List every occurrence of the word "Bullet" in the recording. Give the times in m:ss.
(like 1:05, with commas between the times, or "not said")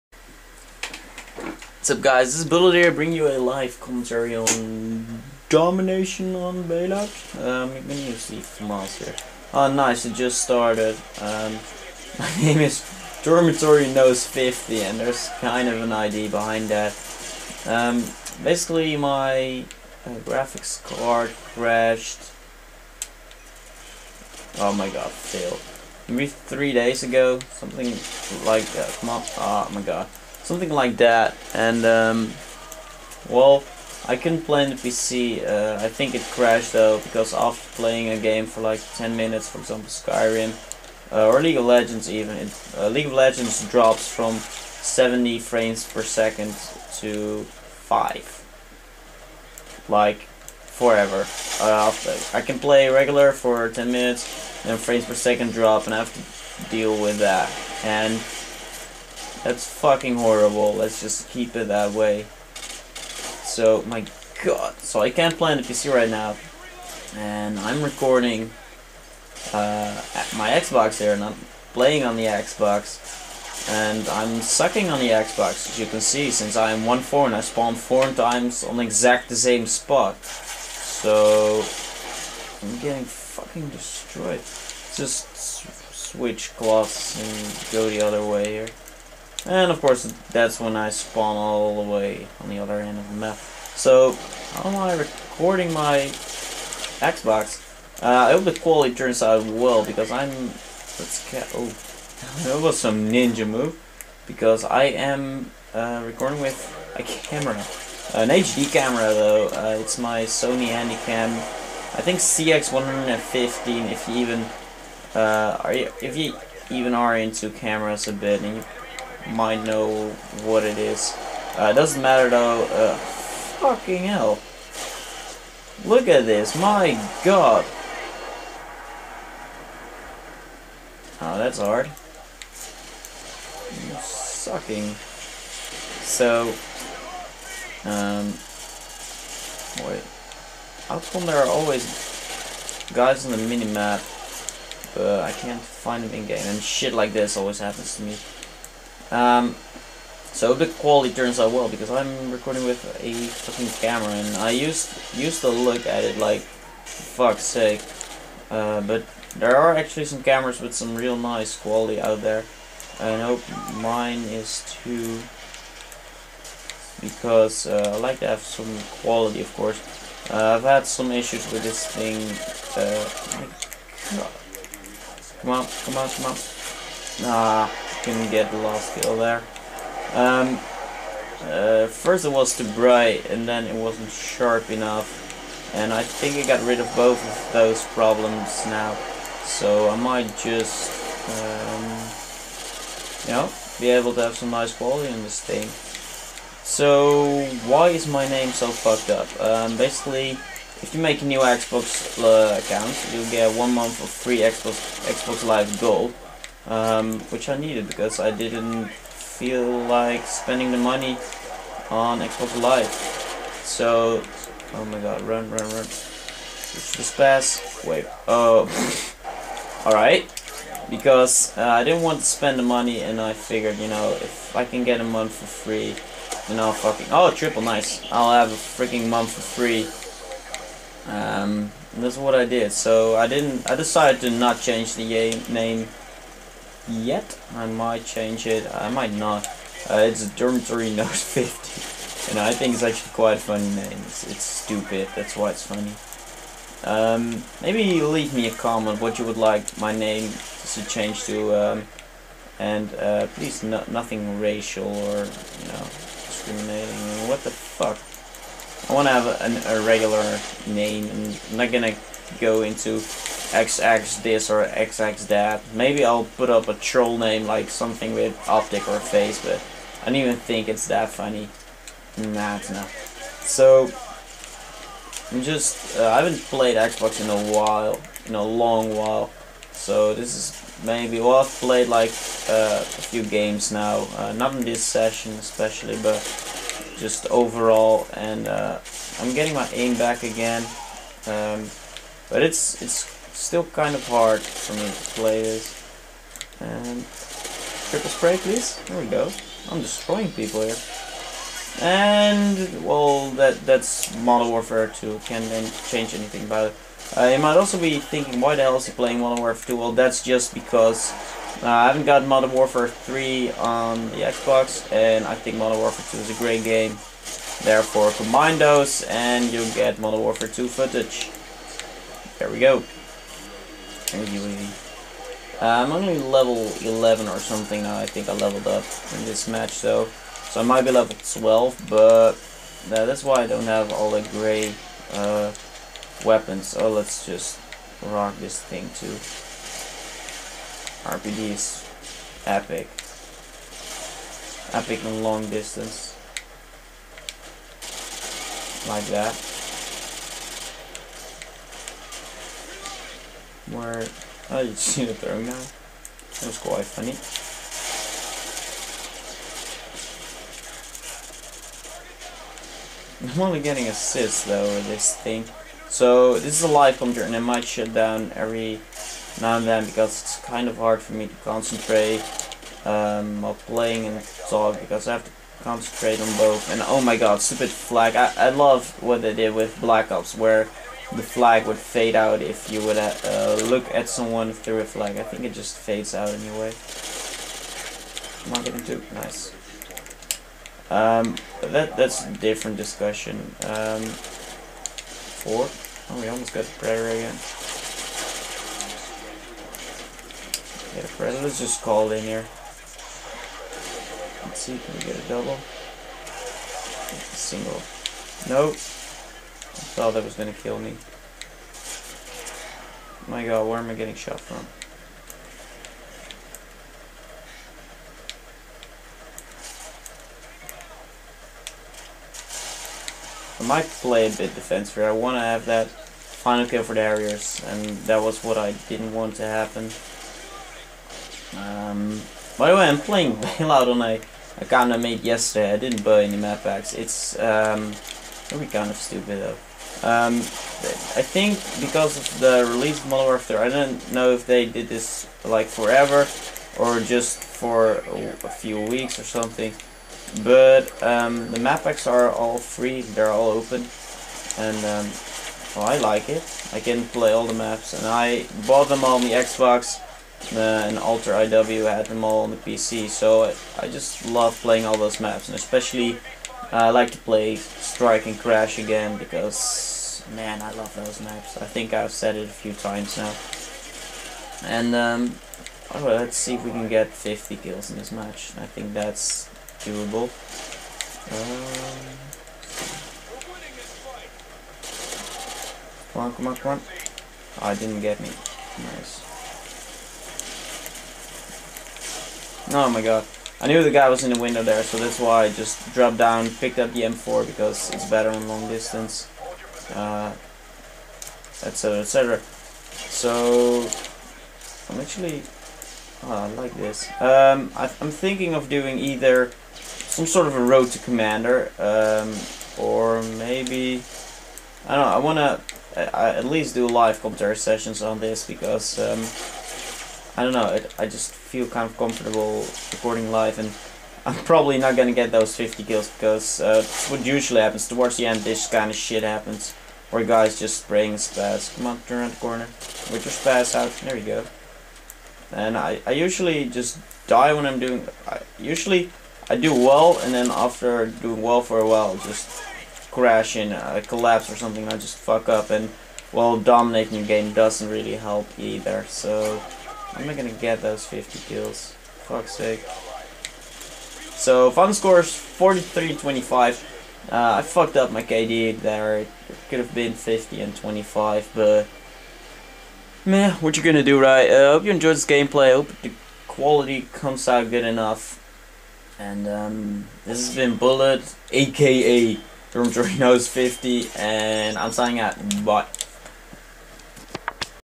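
0:02, 9:30.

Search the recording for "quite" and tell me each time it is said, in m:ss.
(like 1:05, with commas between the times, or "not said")
4:03, 5:56.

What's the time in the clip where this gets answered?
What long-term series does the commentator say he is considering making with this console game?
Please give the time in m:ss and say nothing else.
8:30.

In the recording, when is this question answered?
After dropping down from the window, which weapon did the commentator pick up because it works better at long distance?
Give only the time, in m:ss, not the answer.
8:17.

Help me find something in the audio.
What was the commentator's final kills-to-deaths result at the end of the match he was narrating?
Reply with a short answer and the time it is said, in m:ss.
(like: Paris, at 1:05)
43-25, at 9:15.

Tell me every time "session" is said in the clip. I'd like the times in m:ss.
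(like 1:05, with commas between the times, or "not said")
4:44, 8:37.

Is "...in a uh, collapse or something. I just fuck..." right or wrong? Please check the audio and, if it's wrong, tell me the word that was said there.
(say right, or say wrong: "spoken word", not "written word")
right.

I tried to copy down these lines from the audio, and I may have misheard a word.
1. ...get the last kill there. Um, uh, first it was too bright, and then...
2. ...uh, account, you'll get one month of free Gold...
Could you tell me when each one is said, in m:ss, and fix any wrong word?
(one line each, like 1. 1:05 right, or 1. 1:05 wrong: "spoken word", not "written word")
1. 2:58 right
2. 3:22 wrong: "Xbox", not "Gold".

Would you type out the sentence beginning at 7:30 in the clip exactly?
But um, the map packs are all free, they're all open, and um, well, I like it.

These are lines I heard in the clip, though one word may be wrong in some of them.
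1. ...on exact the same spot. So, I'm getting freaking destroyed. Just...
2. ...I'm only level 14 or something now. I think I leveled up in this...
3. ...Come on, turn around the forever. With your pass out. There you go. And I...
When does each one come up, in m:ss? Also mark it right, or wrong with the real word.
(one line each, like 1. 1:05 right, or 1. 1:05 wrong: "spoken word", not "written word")
1. 1:18 wrong: "fucking", not "freaking"
2. 5:25 wrong: "11", not "14"
3. 8:51 wrong: "corner", not "forever".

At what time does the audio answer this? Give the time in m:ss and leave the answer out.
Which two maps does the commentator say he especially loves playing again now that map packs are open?
7:47.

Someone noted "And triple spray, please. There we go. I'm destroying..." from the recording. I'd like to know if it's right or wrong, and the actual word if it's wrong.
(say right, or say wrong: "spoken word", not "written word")
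right.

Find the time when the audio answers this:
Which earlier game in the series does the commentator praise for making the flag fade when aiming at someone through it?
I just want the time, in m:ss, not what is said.
6:19.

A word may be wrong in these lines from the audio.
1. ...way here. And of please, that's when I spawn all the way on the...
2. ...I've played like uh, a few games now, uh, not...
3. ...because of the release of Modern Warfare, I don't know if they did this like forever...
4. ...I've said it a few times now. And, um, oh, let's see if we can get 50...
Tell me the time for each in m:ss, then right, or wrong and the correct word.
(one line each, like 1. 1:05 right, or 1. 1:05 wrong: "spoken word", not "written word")
1. 1:28 wrong: "course", not "please"
2. 4:41 right
3. 7:21 right
4. 7:51 right.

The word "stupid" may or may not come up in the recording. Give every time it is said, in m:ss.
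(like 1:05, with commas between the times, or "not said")
4:04, 6:17, 7:18.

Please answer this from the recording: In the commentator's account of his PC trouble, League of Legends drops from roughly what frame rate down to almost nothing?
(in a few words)
70 frames per second.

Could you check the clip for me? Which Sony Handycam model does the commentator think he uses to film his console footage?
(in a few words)
CX115.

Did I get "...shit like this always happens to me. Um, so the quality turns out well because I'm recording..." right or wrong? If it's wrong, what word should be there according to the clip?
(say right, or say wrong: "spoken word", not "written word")
right.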